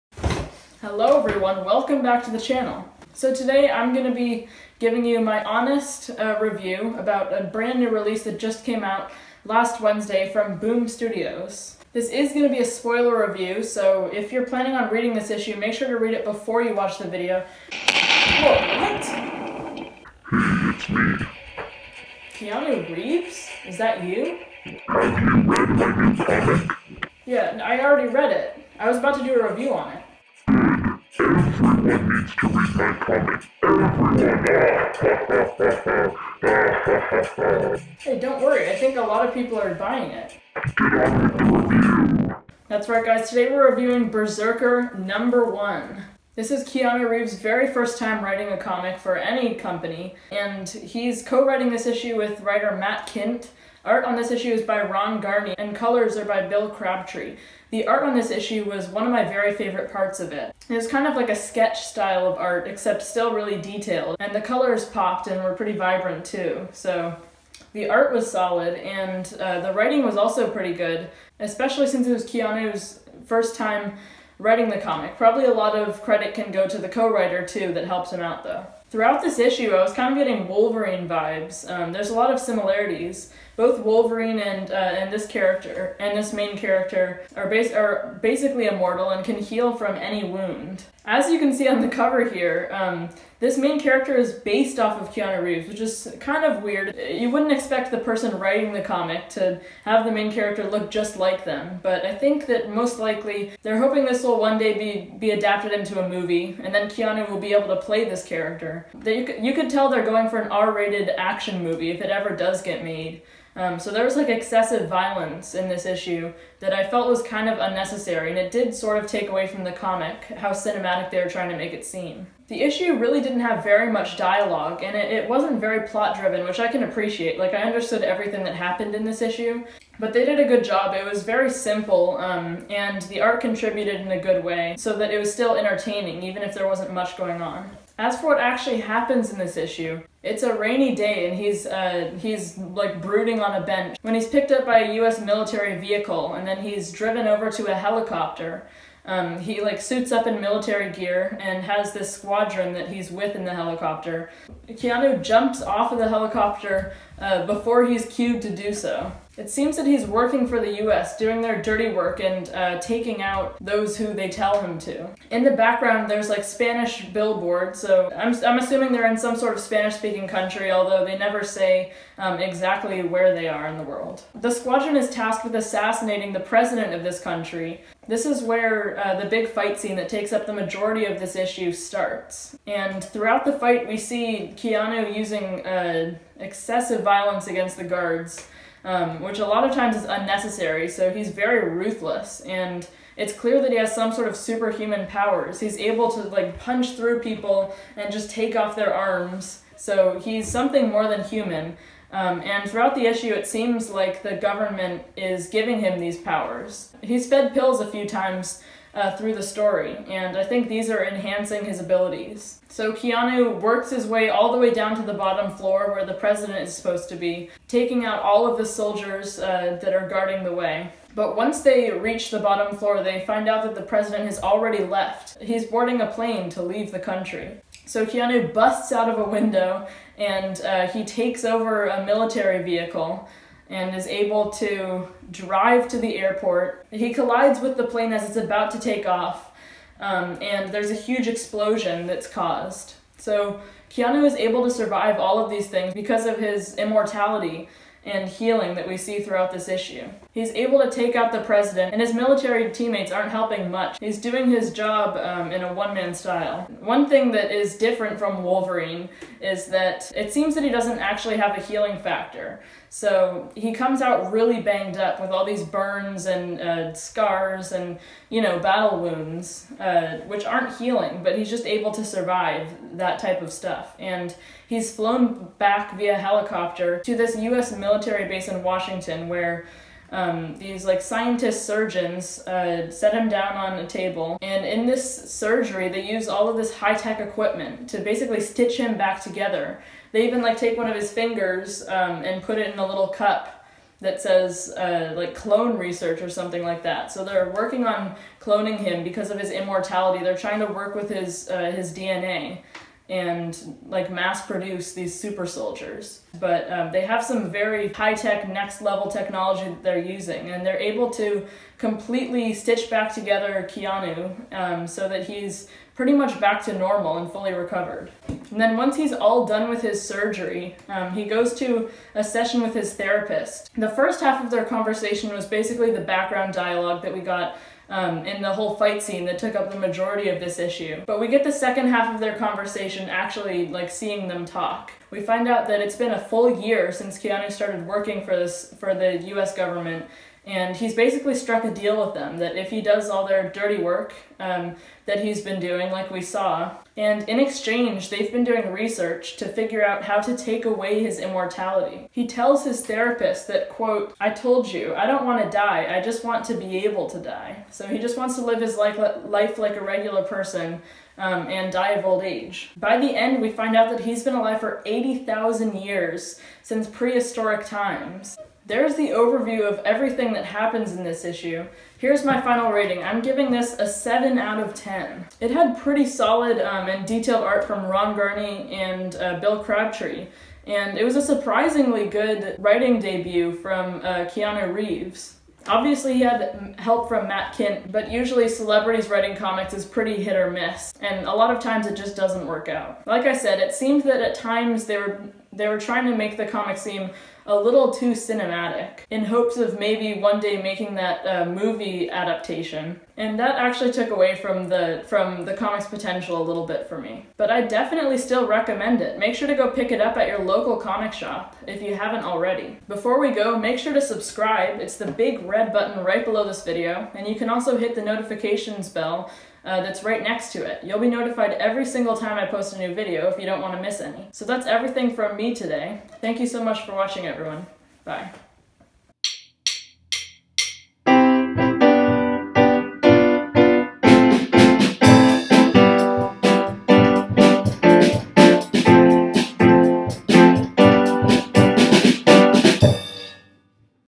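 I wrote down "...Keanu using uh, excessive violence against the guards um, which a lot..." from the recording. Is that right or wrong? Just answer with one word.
right.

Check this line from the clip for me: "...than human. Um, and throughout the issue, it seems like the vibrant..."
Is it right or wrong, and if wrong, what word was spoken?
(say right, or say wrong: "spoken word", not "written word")
wrong: "government", not "vibrant".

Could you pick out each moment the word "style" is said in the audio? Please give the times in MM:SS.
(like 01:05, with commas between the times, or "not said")
01:01, 04:16.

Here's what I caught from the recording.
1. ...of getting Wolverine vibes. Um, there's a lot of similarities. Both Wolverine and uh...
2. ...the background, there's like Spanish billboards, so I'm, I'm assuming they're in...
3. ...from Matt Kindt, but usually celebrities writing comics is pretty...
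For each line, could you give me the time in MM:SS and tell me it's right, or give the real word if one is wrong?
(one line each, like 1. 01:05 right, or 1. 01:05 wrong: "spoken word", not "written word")
1. 01:20 right
2. 02:45 right
3. 06:27 right.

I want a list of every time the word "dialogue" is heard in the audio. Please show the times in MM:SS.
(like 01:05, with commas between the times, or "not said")
02:04, 05:26.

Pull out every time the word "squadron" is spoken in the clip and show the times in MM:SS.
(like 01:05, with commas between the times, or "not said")
02:32, 02:54.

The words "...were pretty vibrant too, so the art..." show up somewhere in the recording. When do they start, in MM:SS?
01:05.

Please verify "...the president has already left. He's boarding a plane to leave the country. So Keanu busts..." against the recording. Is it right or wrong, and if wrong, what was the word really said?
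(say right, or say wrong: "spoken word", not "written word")
right.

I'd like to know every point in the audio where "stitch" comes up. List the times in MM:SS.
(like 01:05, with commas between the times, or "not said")
04:48, 05:12.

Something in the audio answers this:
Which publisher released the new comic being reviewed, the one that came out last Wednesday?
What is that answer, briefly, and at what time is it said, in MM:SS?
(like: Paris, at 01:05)
Boom Studios, at 00:10.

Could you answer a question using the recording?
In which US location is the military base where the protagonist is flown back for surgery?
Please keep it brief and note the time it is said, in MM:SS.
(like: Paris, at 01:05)
Washington, at 04:38.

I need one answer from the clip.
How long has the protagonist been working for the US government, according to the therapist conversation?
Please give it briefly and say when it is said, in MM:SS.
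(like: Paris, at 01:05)
a full year, at 05:36.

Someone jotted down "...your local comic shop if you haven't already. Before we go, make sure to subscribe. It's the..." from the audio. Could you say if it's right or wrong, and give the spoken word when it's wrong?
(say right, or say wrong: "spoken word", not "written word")
right.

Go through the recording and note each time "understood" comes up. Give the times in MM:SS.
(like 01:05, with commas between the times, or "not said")
02:07.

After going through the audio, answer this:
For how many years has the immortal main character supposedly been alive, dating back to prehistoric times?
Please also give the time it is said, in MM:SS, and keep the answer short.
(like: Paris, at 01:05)
80,000, at 06:04.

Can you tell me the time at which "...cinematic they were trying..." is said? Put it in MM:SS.
02:00.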